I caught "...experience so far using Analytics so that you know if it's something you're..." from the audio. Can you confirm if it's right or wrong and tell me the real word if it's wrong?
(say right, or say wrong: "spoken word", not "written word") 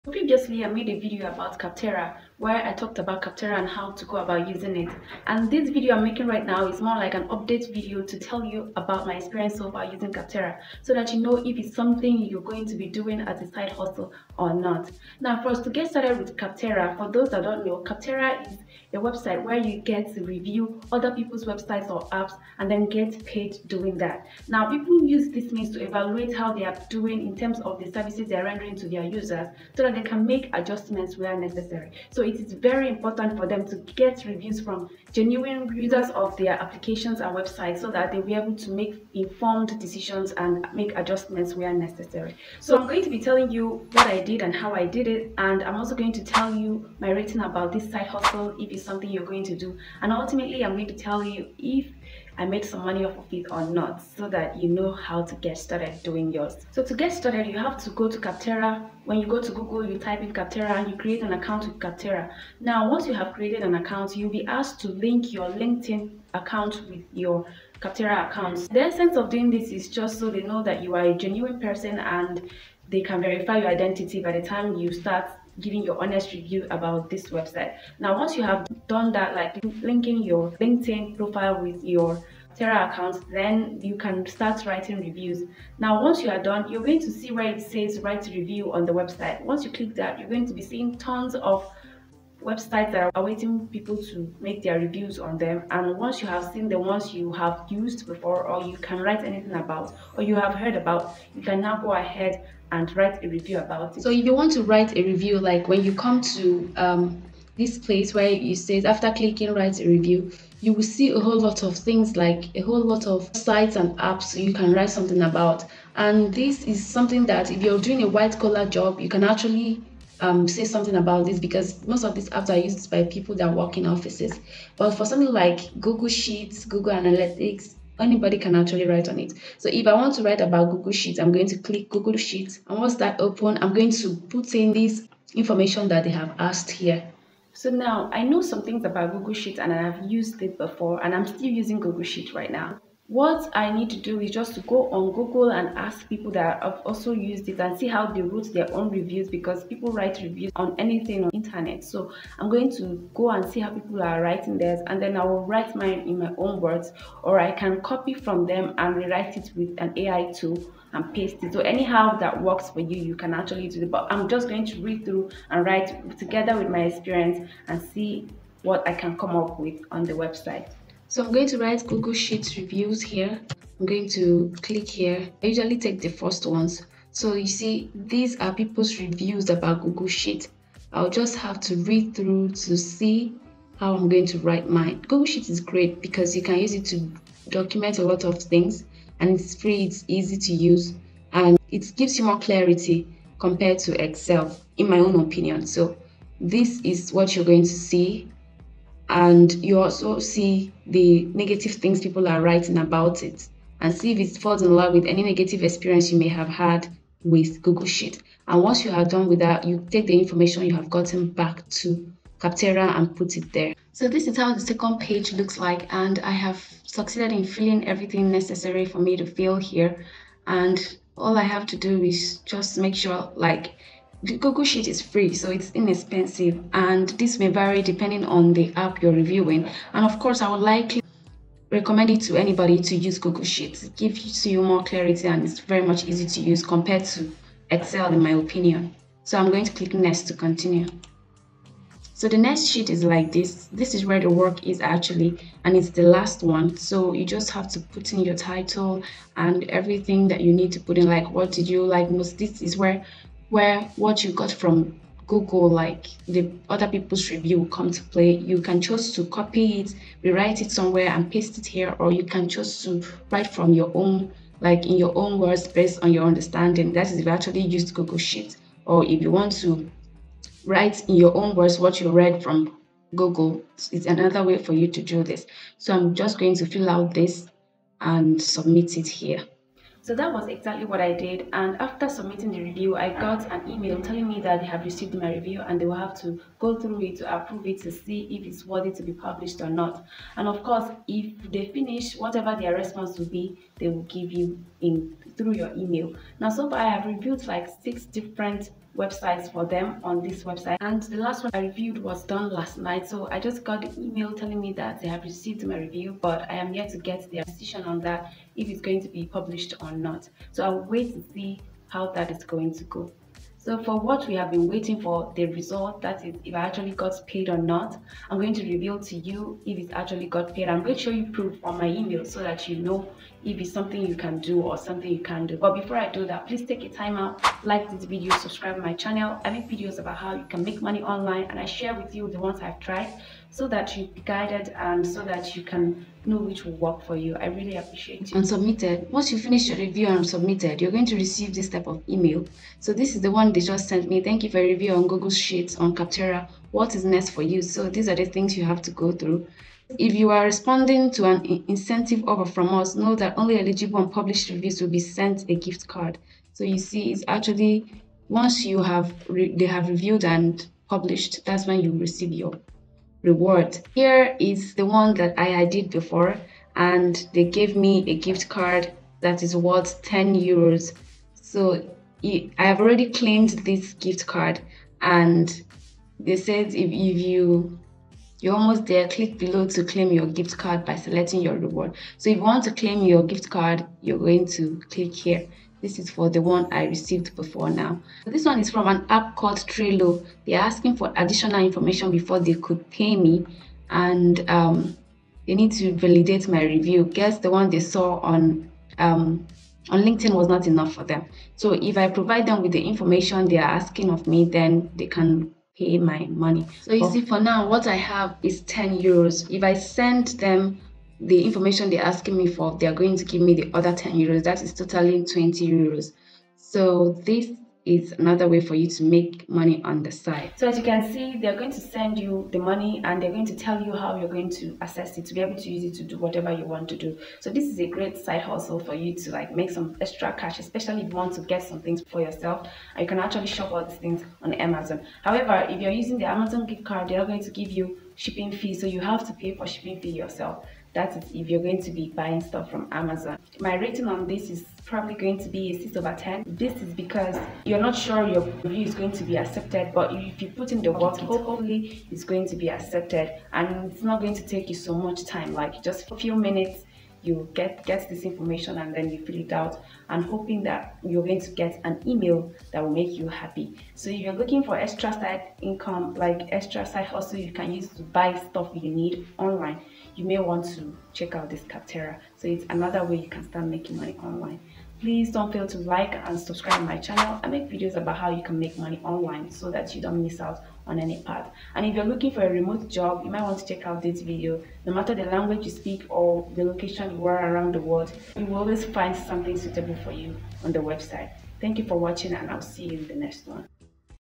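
wrong: "Capterra", not "Analytics".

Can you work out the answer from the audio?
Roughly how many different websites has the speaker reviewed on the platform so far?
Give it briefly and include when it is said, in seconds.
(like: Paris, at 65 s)
6, at 297 s.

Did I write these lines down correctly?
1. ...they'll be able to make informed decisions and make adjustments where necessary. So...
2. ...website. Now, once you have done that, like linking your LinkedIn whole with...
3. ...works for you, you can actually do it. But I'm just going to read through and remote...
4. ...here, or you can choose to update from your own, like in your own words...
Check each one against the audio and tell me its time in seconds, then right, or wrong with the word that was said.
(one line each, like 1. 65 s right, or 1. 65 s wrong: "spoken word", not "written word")
1. 38 s right
2. 77 s wrong: "profile", not "whole"
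3. 162 s wrong: "write", not "remote"
4. 261 s wrong: "write", not "update".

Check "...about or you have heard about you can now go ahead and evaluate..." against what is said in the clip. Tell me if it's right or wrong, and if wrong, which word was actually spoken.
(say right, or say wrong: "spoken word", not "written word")
wrong: "write", not "evaluate".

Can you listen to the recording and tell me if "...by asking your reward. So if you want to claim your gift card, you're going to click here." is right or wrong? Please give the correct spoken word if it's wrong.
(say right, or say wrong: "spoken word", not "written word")
wrong: "selecting", not "asking".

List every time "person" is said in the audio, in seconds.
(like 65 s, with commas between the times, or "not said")
71 s.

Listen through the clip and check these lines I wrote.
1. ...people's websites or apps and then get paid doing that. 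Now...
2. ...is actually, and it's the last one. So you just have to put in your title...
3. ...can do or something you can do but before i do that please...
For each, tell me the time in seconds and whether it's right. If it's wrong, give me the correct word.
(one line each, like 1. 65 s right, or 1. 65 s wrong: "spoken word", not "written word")
1. 21 s right
2. 244 s right
3. 324 s right.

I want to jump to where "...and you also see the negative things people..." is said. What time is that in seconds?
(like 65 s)
199 s.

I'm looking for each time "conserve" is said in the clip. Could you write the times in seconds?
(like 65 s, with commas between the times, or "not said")
not said.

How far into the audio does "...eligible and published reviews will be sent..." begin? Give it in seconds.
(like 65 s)
353 s.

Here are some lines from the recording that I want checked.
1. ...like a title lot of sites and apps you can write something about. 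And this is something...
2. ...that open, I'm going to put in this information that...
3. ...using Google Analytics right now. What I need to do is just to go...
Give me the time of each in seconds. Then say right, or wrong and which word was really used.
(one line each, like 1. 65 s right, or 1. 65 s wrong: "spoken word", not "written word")
1. 112 s wrong: "whole", not "title"
2. 132 s right
3. 141 s wrong: "Sheets", not "Analytics".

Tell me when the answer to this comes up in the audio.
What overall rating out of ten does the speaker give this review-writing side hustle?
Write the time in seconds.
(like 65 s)
445 s.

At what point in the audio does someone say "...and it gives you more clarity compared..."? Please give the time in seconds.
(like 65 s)
191 s.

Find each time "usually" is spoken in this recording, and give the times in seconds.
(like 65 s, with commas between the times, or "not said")
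175 s.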